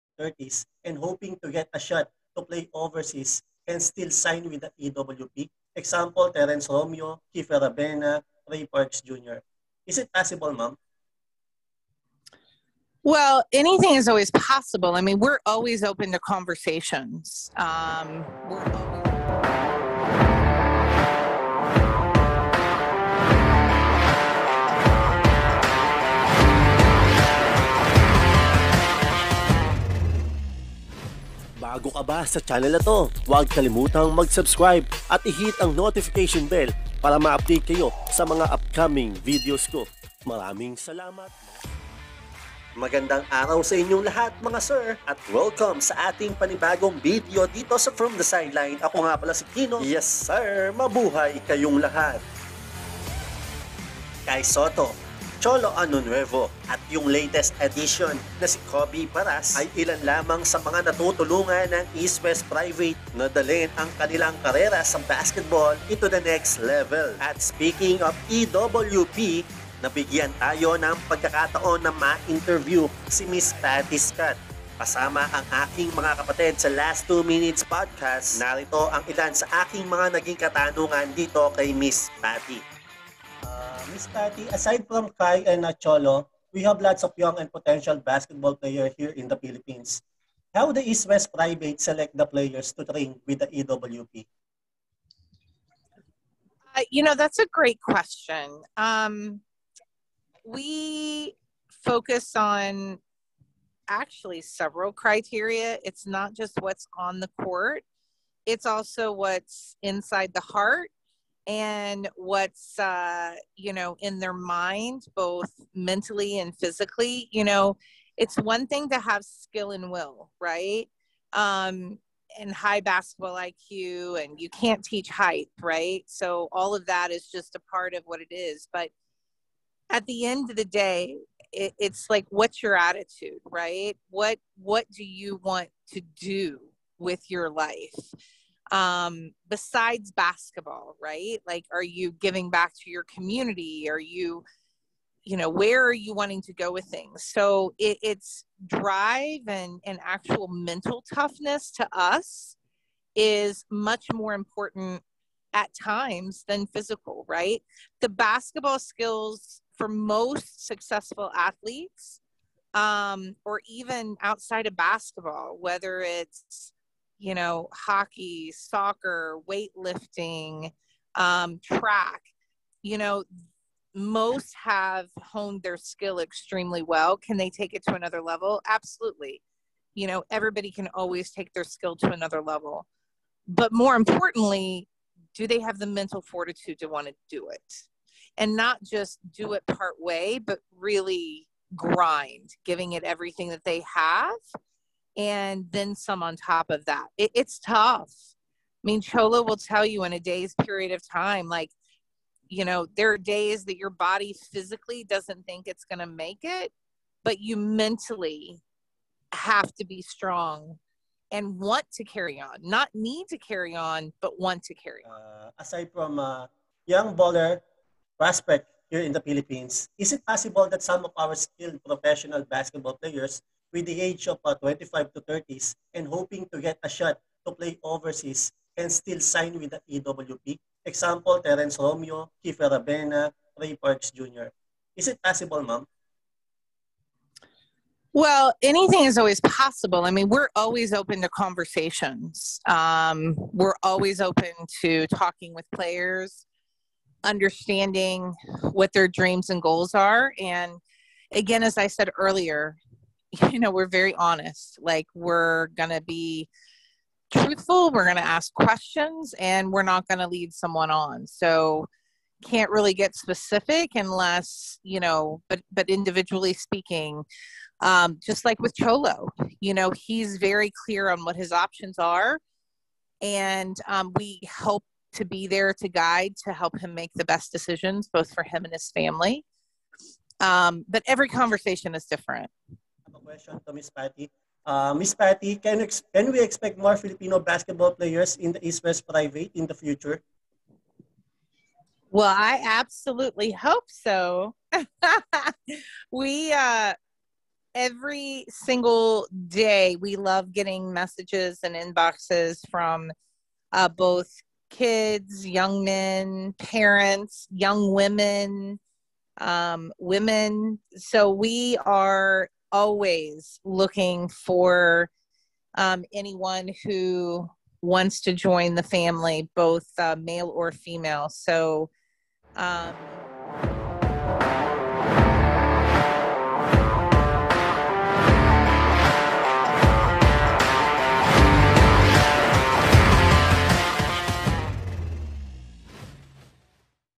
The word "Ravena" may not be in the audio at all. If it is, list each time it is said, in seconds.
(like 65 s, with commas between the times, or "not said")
7 s, 232 s.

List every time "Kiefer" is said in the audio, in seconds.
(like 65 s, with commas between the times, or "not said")
7 s, 232 s.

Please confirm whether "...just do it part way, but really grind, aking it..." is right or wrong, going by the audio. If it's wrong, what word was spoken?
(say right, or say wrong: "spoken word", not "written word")
wrong: "giving", not "aking".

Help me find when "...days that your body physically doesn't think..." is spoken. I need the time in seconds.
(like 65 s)
203 s.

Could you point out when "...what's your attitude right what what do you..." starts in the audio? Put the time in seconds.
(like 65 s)
132 s.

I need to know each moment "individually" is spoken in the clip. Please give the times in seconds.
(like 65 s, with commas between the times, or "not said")
265 s.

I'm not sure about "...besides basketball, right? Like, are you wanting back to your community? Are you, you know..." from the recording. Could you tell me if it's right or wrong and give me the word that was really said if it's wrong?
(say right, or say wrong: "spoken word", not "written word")
wrong: "giving", not "wanting".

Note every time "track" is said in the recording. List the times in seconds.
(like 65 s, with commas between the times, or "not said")
171 s.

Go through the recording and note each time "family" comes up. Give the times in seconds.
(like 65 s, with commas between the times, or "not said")
278 s, 318 s.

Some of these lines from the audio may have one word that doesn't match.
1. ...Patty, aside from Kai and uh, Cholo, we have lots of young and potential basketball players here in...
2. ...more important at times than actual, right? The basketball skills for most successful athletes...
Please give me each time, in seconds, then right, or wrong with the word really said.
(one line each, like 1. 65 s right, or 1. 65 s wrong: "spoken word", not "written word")
1. 84 s right
2. 154 s wrong: "physical", not "actual".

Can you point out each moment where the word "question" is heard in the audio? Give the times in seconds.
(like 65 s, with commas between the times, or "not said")
97 s, 258 s, 283 s.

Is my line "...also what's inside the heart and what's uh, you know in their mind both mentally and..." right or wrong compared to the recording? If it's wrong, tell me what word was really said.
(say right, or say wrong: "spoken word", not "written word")
right.